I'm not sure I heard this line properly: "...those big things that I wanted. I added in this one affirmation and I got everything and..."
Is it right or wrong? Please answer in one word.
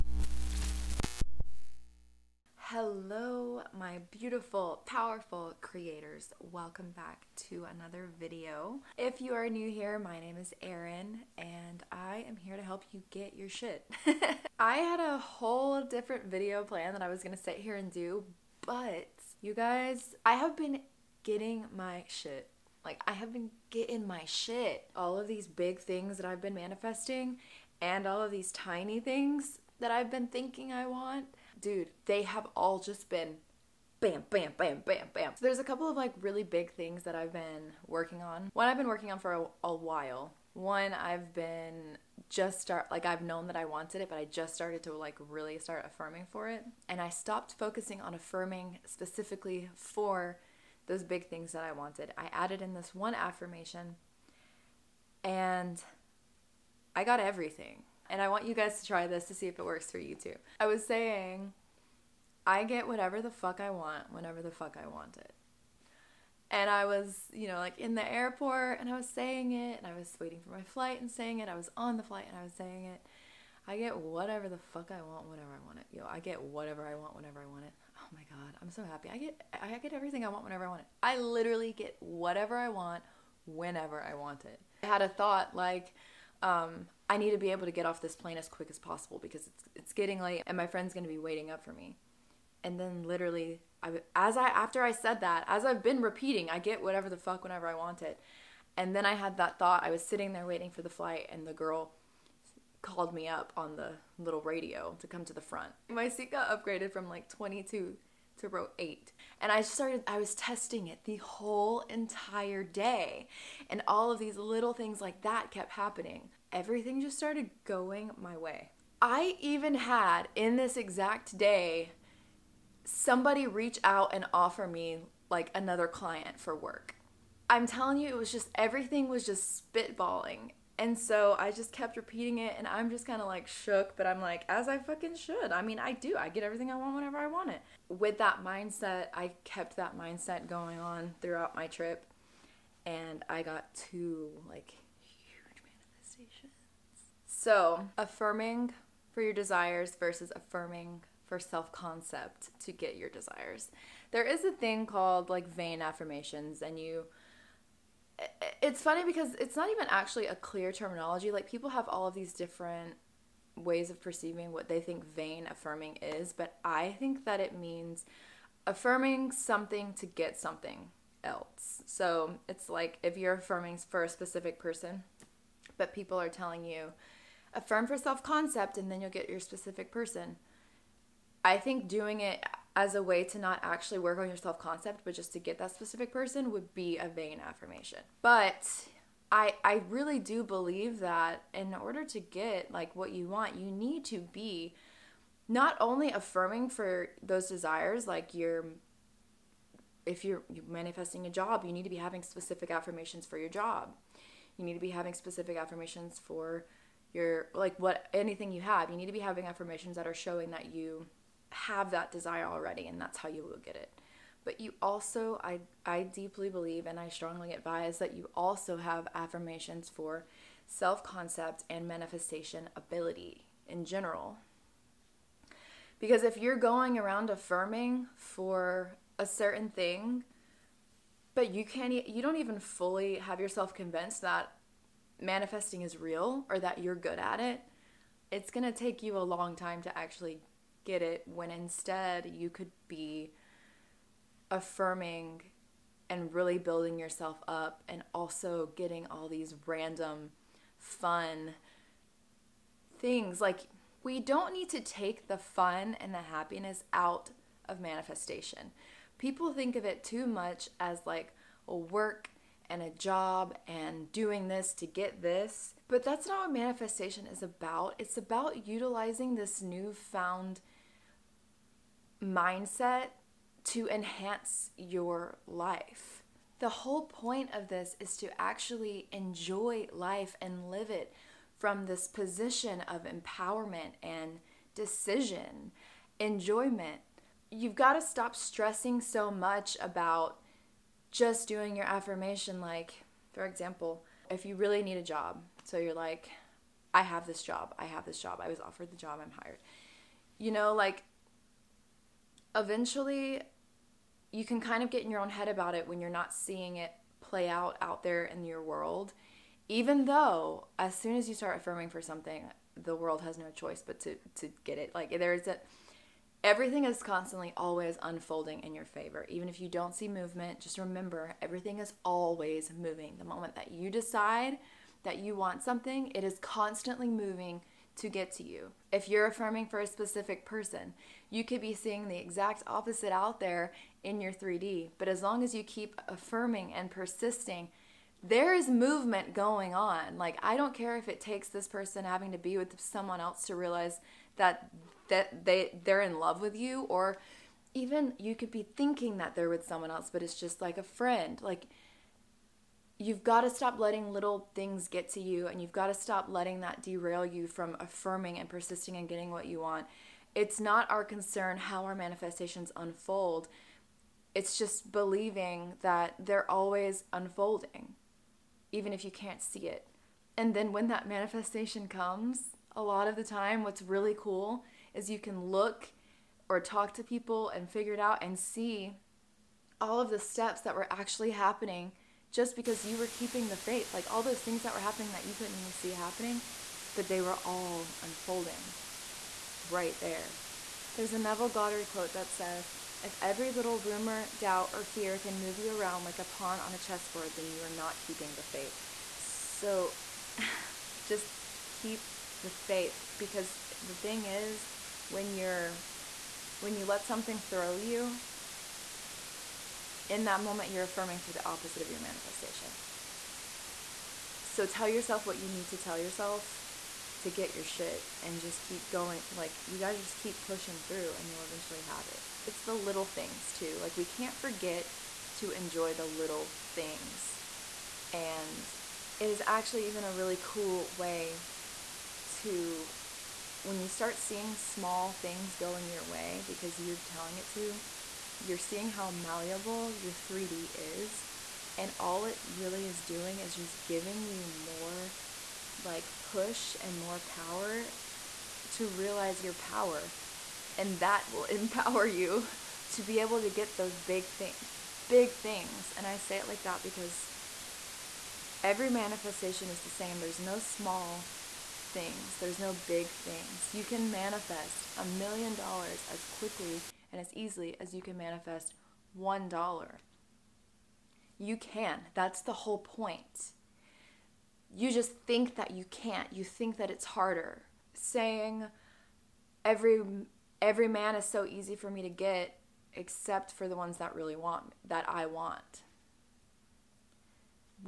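right.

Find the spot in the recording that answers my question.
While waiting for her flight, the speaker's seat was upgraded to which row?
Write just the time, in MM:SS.
01:48.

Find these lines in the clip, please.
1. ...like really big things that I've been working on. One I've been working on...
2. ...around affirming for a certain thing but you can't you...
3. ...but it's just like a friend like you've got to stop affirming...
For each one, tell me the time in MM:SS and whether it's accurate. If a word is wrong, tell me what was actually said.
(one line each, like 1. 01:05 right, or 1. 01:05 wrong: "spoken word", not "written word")
1. 00:35 right
2. 03:46 right
3. 05:50 wrong: "letting", not "affirming".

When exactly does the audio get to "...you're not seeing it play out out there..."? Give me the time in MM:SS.
05:06.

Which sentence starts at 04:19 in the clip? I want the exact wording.
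People think of it too much as like a work and a job and doing this to get this.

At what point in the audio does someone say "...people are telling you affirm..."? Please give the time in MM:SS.
02:55.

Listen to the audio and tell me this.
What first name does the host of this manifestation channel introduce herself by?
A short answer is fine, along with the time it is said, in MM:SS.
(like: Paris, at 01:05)
Erin, at 00:10.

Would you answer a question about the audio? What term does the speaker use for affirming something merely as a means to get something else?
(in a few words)
Vain affirmations.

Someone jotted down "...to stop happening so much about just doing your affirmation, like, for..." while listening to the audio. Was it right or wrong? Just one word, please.
wrong.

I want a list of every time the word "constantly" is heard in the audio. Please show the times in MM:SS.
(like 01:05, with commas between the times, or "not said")
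05:17, 05:26.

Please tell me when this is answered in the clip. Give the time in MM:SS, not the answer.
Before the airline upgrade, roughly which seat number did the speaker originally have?
01:47.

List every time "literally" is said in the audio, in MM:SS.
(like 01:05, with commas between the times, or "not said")
01:21, 01:33.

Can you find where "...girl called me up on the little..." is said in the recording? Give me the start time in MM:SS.
01:41.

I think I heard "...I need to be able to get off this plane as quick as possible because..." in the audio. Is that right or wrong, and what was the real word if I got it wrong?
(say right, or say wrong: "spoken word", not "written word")
right.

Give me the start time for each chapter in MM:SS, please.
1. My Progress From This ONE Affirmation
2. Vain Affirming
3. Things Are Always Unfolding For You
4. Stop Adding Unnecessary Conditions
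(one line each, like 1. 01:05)
1. 00:24
2. 02:27
3. 04:15
4. 07:01.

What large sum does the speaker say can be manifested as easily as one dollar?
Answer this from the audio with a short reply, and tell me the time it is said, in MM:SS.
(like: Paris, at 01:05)
$1,000,000, at 07:44.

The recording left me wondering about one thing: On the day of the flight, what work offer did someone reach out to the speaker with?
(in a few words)
Another client.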